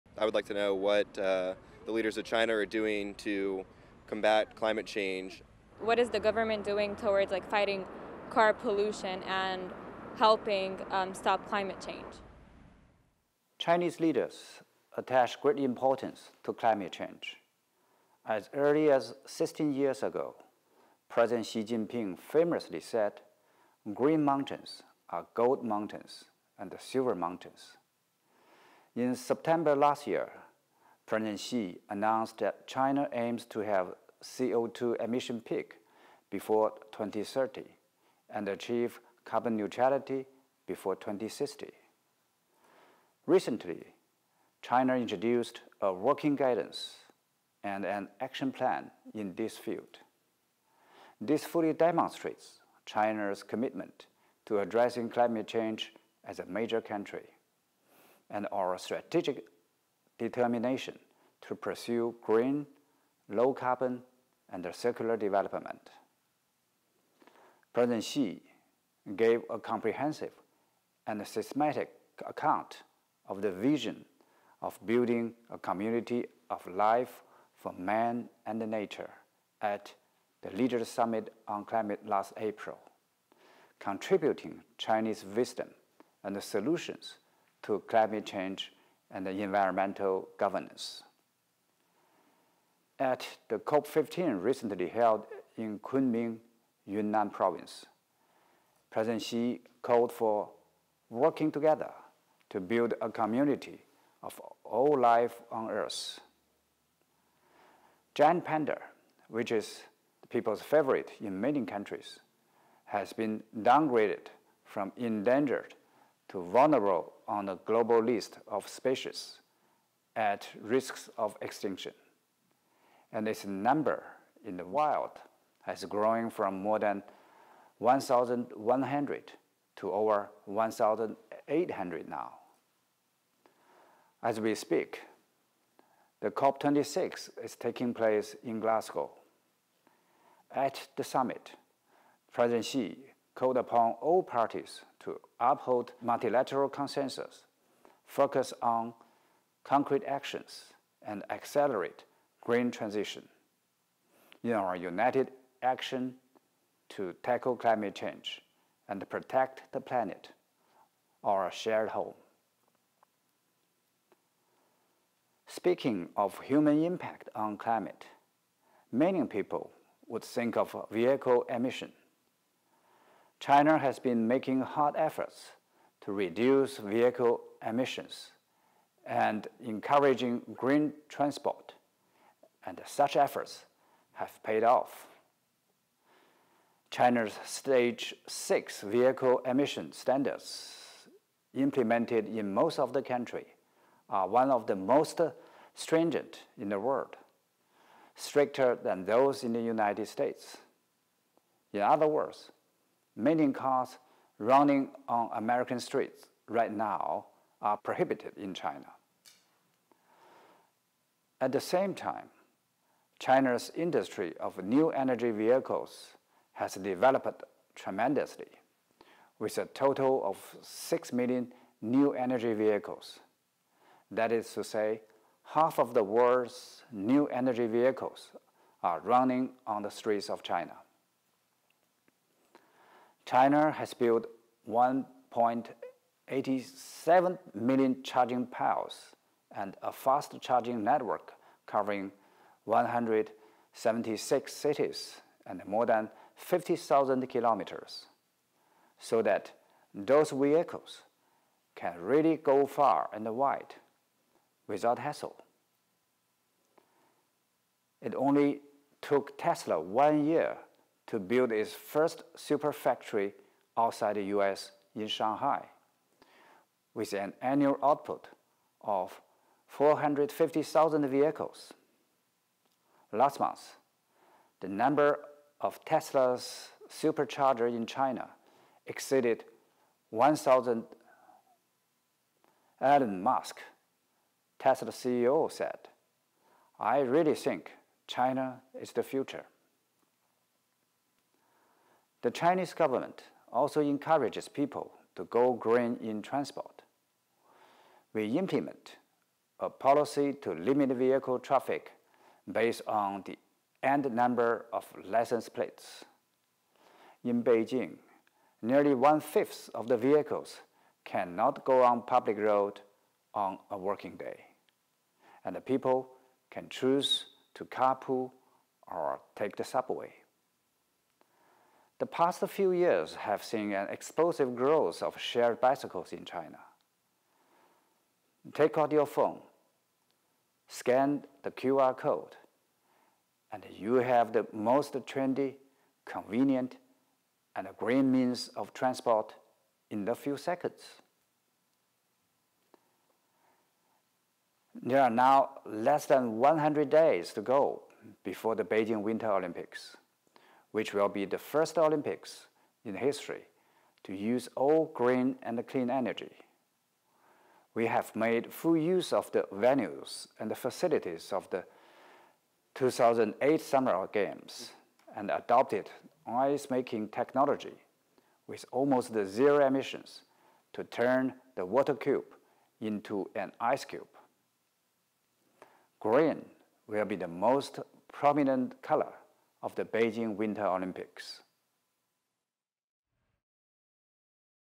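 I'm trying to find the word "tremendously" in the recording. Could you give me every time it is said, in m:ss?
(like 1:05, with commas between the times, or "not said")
3:37.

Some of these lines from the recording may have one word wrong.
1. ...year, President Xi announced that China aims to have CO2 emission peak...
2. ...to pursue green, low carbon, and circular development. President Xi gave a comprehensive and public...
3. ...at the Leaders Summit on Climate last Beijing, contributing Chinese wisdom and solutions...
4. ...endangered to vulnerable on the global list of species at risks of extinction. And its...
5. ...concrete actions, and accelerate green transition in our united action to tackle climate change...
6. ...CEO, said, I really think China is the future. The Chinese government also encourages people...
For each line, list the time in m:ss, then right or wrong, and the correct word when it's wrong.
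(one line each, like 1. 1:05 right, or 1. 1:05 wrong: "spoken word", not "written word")
1. 0:30 right
2. 1:01 wrong: "systematic", not "public"
3. 1:19 wrong: "April", not "Beijing"
4. 1:54 right
5. 2:29 right
6. 4:44 right.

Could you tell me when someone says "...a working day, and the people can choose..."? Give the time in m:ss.
5:13.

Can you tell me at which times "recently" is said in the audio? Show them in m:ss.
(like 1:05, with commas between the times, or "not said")
0:43, 1:34.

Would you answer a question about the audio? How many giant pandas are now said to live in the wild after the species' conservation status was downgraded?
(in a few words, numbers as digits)
over 1,800.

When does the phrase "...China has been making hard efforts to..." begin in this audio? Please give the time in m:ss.
2:53.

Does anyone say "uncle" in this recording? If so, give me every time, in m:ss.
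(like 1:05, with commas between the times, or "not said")
not said.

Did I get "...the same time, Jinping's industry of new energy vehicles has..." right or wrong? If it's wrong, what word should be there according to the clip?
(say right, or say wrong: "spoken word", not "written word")
wrong: "China", not "Jinping".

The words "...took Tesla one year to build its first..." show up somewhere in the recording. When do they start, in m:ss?
4:19.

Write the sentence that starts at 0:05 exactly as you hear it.
What is the government doing towards like fighting car pollution and helping um, stop climate change?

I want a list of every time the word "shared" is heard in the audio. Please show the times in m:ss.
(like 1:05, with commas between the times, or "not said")
2:41, 5:25.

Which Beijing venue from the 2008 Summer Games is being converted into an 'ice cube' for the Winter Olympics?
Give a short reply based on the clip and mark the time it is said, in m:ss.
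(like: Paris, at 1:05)
the Water Cube, at 6:11.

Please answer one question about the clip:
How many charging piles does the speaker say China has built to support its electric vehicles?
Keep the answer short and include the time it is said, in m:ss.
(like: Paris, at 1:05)
1.87 million, at 3:54.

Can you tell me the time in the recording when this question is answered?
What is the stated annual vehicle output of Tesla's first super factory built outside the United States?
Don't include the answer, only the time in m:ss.
4:29.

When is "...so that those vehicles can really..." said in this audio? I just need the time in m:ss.
4:08.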